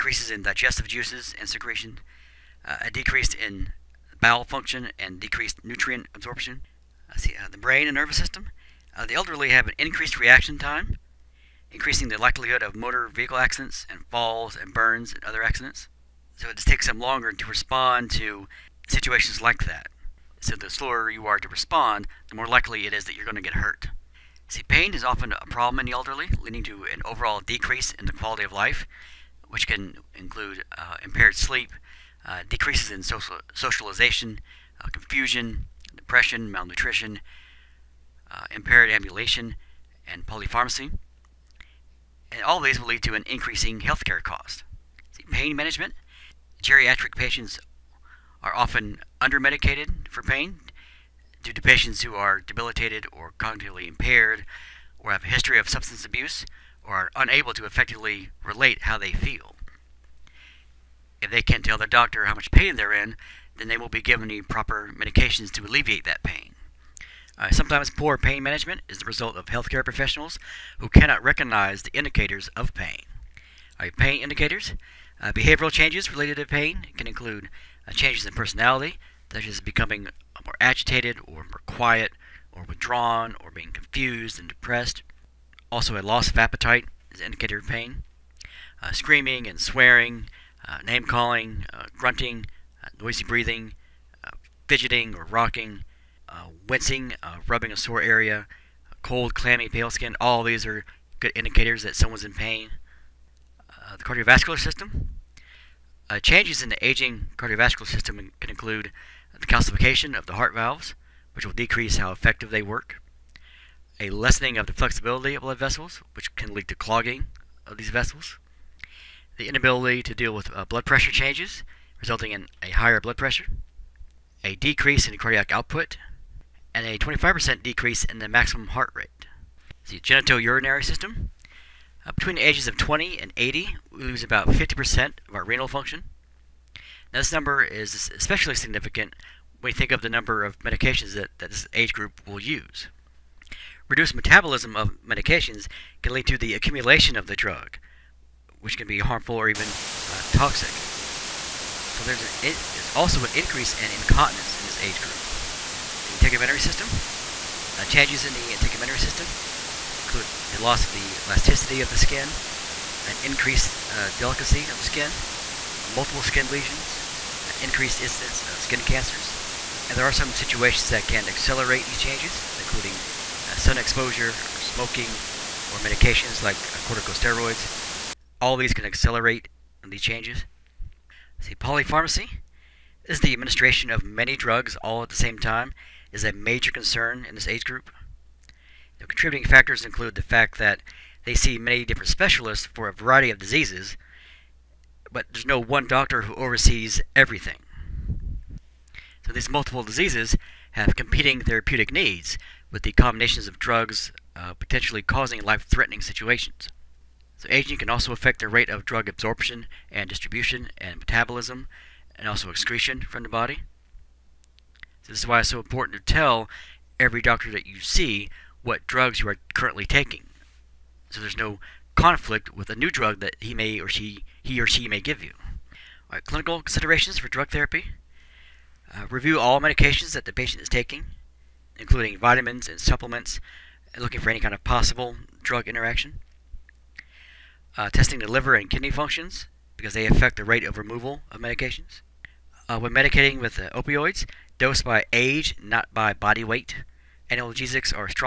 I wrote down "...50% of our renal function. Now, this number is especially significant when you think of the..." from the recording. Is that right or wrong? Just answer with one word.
right.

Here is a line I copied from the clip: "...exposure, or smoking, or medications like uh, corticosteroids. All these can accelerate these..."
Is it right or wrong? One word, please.
right.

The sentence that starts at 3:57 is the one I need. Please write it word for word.
Uh, testing the liver and kidney functions because they affect the rate of removal of medications.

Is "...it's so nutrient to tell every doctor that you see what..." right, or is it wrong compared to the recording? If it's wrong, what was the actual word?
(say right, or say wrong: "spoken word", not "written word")
wrong: "important", not "nutrient".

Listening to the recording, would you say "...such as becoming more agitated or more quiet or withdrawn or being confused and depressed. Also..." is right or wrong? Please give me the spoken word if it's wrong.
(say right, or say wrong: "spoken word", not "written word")
right.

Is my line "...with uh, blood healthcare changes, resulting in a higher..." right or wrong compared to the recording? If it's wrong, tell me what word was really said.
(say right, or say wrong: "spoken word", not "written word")
wrong: "pressure", not "healthcare".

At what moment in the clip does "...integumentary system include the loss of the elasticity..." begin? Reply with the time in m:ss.
2:38.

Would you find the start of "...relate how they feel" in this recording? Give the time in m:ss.
0:58.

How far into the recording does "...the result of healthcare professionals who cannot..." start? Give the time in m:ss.
1:08.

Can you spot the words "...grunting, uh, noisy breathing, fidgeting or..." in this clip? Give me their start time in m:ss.
1:31.